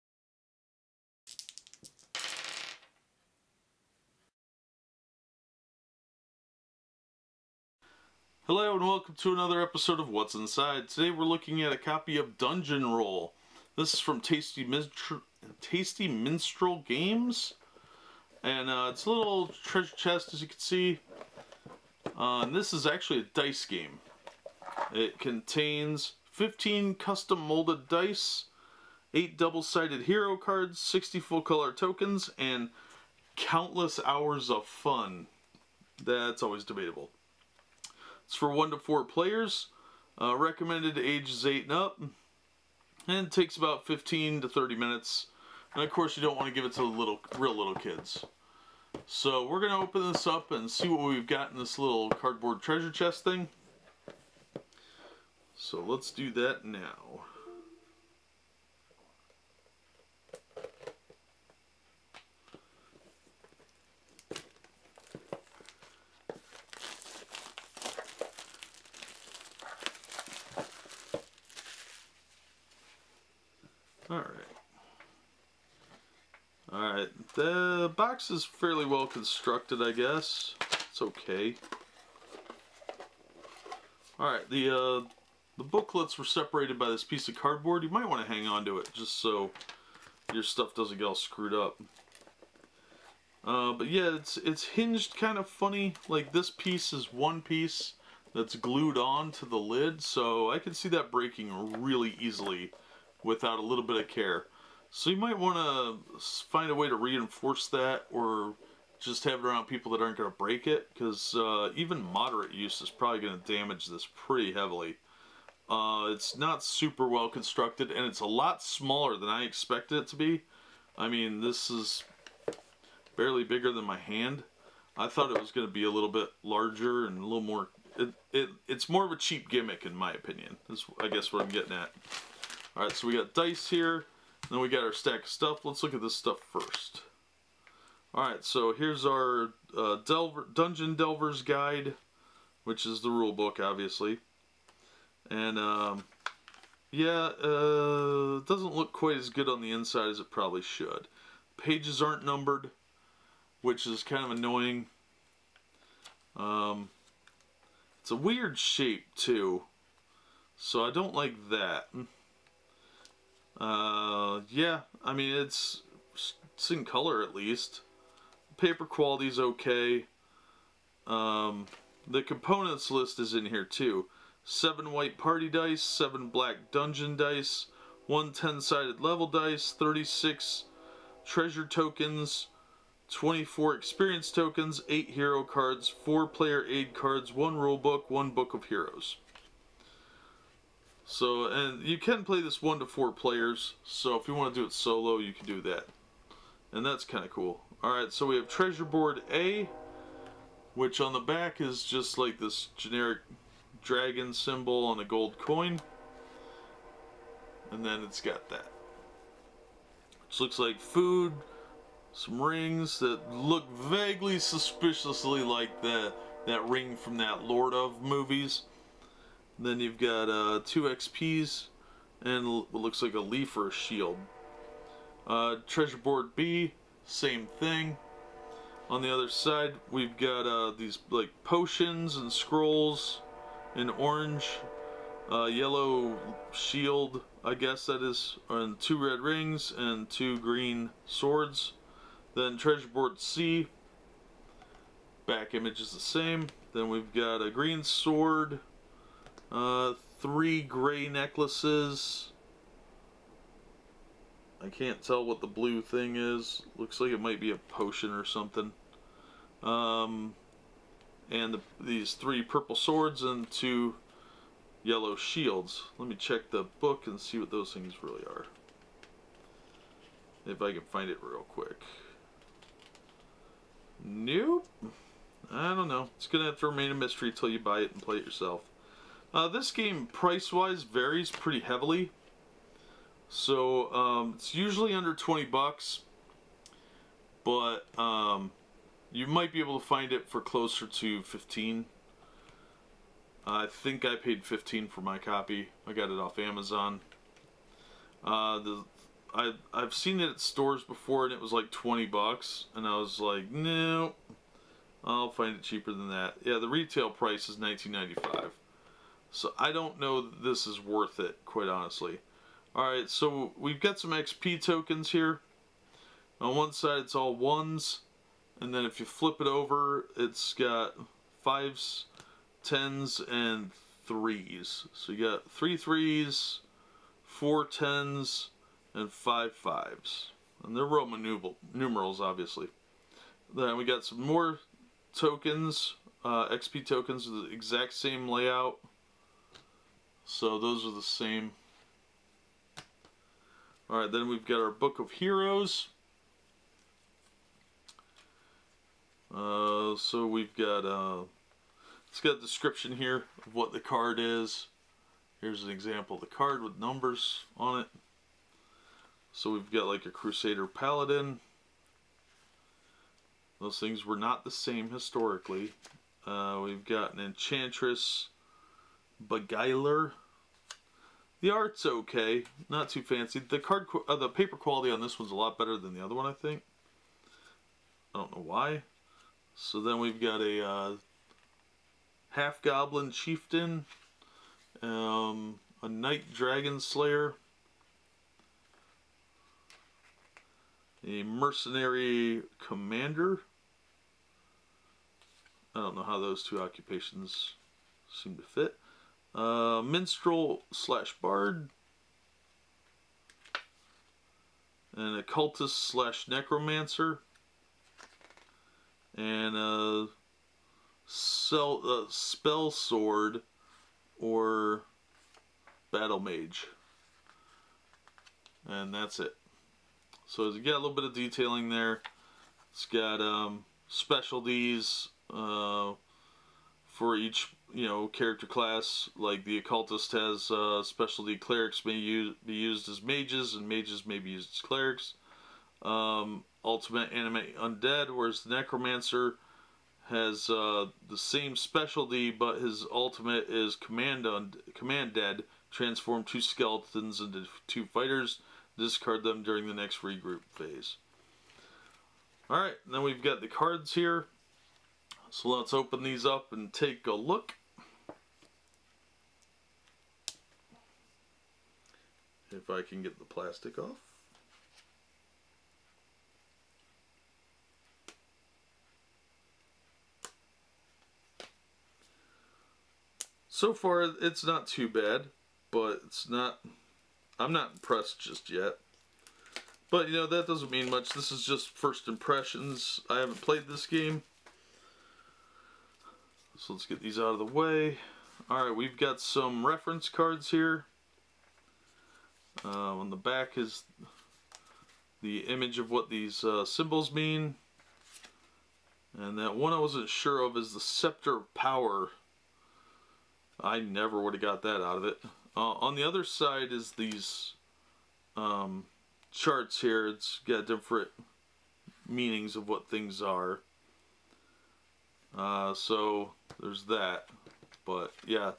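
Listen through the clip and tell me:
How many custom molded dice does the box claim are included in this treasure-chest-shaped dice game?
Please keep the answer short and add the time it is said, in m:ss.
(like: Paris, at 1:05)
15, at 0:26.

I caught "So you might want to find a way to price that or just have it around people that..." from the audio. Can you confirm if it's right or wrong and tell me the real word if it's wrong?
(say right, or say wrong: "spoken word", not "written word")
wrong: "reinforce", not "price".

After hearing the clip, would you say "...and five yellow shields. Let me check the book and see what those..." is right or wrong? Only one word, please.
wrong.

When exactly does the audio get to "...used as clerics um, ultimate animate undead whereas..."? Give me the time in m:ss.
7:14.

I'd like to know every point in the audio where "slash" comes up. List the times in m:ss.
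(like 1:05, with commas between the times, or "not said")
6:40, 6:45.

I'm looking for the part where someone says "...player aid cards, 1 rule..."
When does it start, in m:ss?
3:06.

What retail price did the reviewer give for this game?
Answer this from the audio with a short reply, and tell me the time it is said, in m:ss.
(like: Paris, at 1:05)
$19.95, at 5:07.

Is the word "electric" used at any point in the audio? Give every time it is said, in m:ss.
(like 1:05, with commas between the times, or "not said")
not said.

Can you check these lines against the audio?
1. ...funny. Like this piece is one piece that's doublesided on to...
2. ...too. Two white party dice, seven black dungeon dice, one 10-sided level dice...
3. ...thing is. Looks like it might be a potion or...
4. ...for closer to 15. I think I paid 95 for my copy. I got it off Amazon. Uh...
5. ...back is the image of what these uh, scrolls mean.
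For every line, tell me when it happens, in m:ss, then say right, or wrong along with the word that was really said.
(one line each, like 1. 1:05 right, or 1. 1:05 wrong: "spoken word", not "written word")
1. 1:35 wrong: "glued", not "doublesided"
2. 2:53 wrong: "Seven", not "Two"
3. 4:15 right
4. 4:50 wrong: "15", not "95"
5. 8:13 wrong: "symbols", not "scrolls".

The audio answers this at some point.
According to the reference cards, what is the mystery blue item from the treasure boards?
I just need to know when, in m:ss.
8:20.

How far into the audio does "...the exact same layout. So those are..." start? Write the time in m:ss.
5:37.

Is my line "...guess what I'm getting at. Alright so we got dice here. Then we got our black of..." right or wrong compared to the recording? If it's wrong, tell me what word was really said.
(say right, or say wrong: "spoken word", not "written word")
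wrong: "stack", not "black".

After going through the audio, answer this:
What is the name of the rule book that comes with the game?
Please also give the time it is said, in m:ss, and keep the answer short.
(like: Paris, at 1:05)
Dungeon Delver's Guide, at 2:20.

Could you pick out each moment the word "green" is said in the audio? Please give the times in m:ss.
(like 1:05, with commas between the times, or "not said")
4:00, 4:07.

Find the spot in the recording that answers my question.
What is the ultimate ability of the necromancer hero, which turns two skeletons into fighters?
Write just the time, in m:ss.
7:24.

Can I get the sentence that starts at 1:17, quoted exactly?
The box is fairly well constructed, I guess.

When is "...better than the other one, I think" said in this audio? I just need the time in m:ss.
6:15.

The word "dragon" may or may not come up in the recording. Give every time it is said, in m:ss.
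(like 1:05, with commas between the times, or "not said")
3:23, 6:26.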